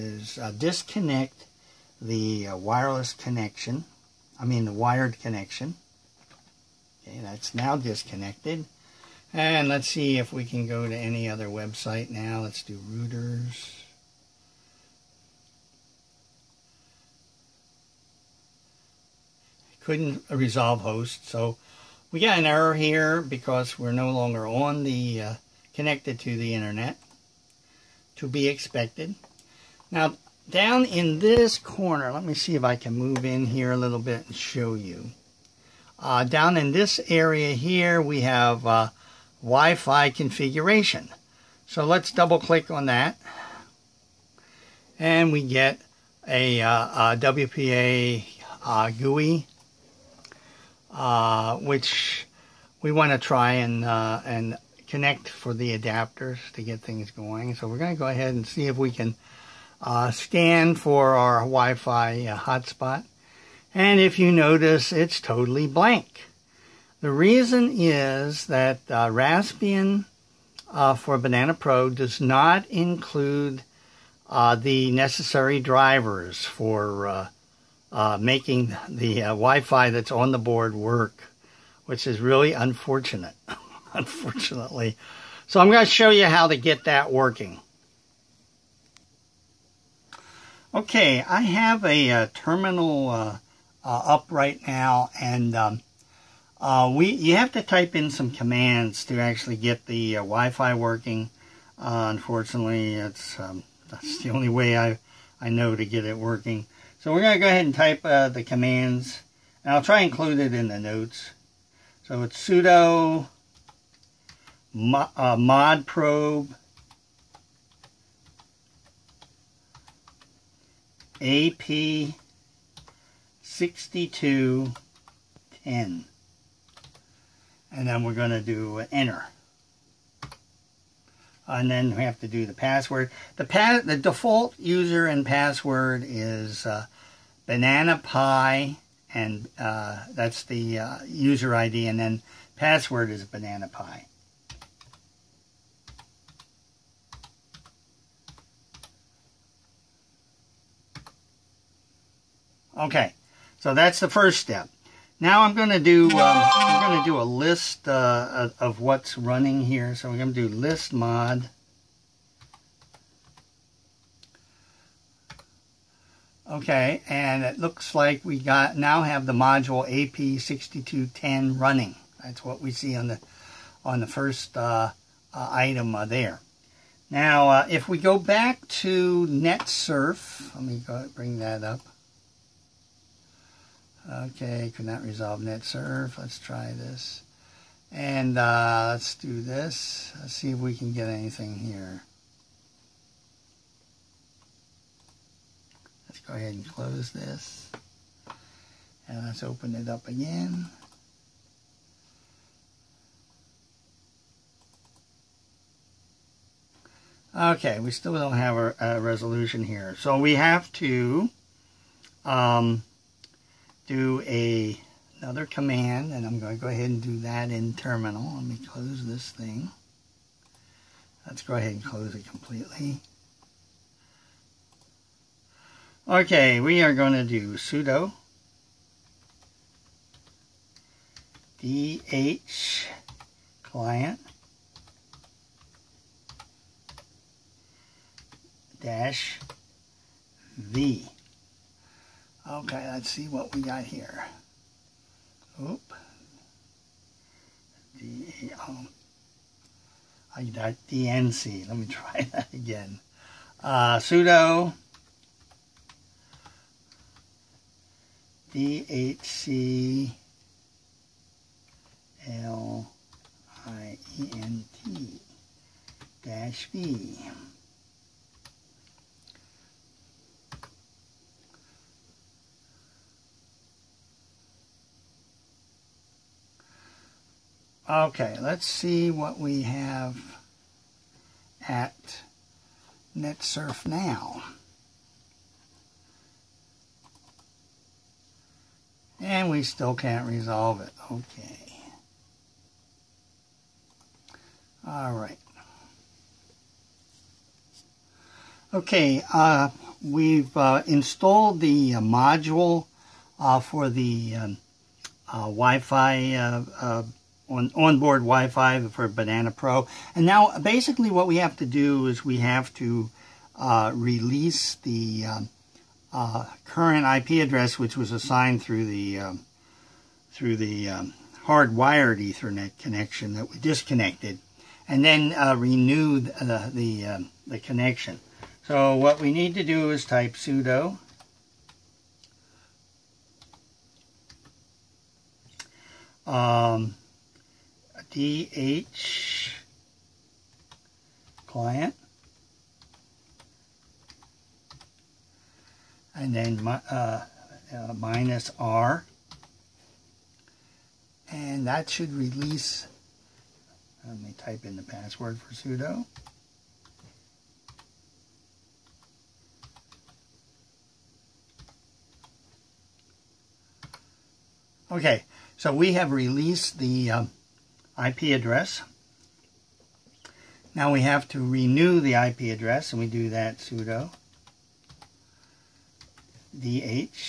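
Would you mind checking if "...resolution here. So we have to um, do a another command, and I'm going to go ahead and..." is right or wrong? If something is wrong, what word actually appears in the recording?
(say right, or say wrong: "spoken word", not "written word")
right.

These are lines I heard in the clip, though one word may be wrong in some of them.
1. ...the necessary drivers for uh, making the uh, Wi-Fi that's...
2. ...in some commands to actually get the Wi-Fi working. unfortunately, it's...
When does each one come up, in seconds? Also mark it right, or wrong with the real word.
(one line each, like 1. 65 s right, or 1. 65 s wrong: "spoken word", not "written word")
1. 74 s right
2. 97 s right.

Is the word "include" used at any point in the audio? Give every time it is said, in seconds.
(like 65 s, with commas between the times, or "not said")
72 s, 110 s.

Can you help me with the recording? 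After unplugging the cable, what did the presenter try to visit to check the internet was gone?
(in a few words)
routers.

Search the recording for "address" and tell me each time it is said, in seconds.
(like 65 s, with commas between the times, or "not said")
317 s, 368 s, 372 s.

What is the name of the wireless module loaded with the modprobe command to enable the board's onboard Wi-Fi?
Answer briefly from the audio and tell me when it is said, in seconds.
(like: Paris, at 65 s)
AP6210, at 121 s.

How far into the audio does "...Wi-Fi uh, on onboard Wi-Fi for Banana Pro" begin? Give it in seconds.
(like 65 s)
305 s.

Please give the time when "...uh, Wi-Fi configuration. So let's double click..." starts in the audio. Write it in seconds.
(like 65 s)
38 s.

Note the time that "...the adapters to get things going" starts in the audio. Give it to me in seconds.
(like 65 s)
55 s.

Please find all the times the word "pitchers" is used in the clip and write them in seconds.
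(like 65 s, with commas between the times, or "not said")
not said.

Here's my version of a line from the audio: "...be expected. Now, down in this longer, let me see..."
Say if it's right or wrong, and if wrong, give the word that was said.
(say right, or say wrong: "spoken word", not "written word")
wrong: "corner", not "longer".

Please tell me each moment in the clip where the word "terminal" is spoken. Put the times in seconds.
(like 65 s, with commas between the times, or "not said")
92 s, 217 s.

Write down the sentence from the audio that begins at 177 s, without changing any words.
Now, uh, if we go back to NetSurf, let me go, bring that up.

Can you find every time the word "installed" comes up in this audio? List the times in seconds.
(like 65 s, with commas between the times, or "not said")
300 s.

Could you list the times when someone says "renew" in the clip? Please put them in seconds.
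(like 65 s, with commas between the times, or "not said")
325 s, 371 s.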